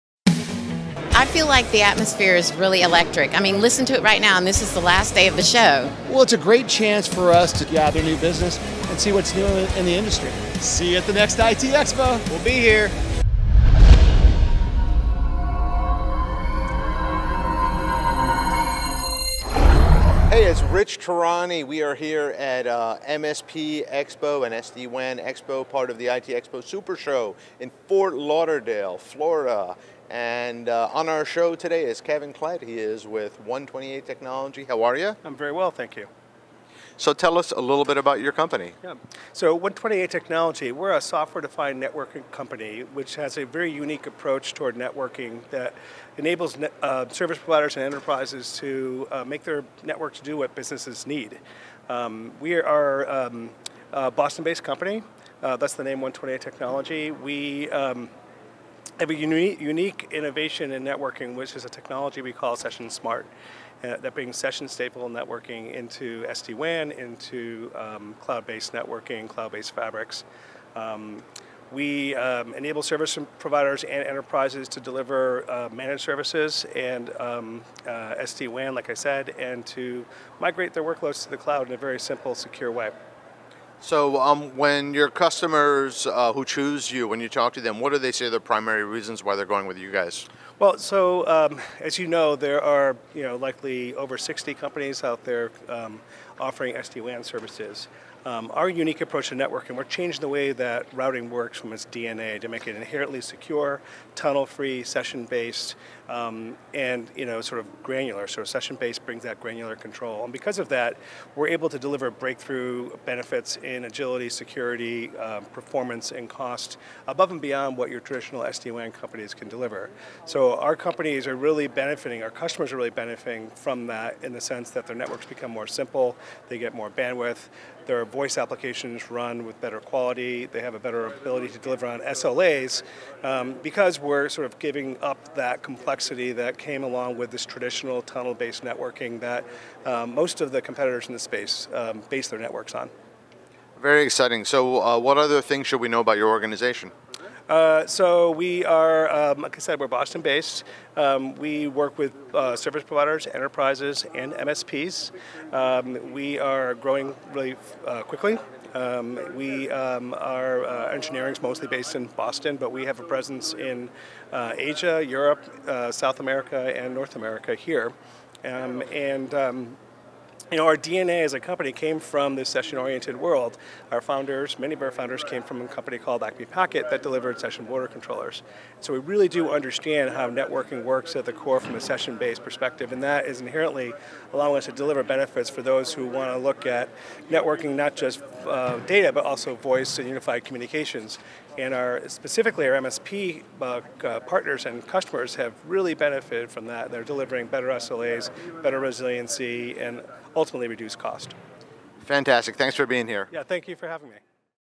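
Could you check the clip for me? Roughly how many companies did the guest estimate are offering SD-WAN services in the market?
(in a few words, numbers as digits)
over 60.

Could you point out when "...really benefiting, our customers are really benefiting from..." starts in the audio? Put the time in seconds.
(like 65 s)
121 s.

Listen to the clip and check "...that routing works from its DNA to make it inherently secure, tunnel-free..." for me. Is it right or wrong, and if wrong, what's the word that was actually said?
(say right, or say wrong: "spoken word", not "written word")
right.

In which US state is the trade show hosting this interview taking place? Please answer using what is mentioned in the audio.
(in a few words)
Florida.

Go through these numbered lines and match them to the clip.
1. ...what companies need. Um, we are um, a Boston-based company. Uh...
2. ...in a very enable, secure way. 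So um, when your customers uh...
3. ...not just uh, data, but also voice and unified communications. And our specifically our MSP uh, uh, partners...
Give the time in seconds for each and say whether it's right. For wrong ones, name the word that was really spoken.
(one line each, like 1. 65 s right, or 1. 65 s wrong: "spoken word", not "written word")
1. 50 s wrong: "businesses", not "companies"
2. 81 s wrong: "simple", not "enable"
3. 187 s right.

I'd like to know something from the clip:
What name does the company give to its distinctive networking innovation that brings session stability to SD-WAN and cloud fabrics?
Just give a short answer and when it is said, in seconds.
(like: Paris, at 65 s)
Session Smart, at 62 s.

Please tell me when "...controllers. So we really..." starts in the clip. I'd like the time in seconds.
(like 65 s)
177 s.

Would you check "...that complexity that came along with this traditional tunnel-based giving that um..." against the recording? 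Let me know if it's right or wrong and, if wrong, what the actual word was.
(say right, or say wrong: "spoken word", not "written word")
wrong: "networking", not "giving".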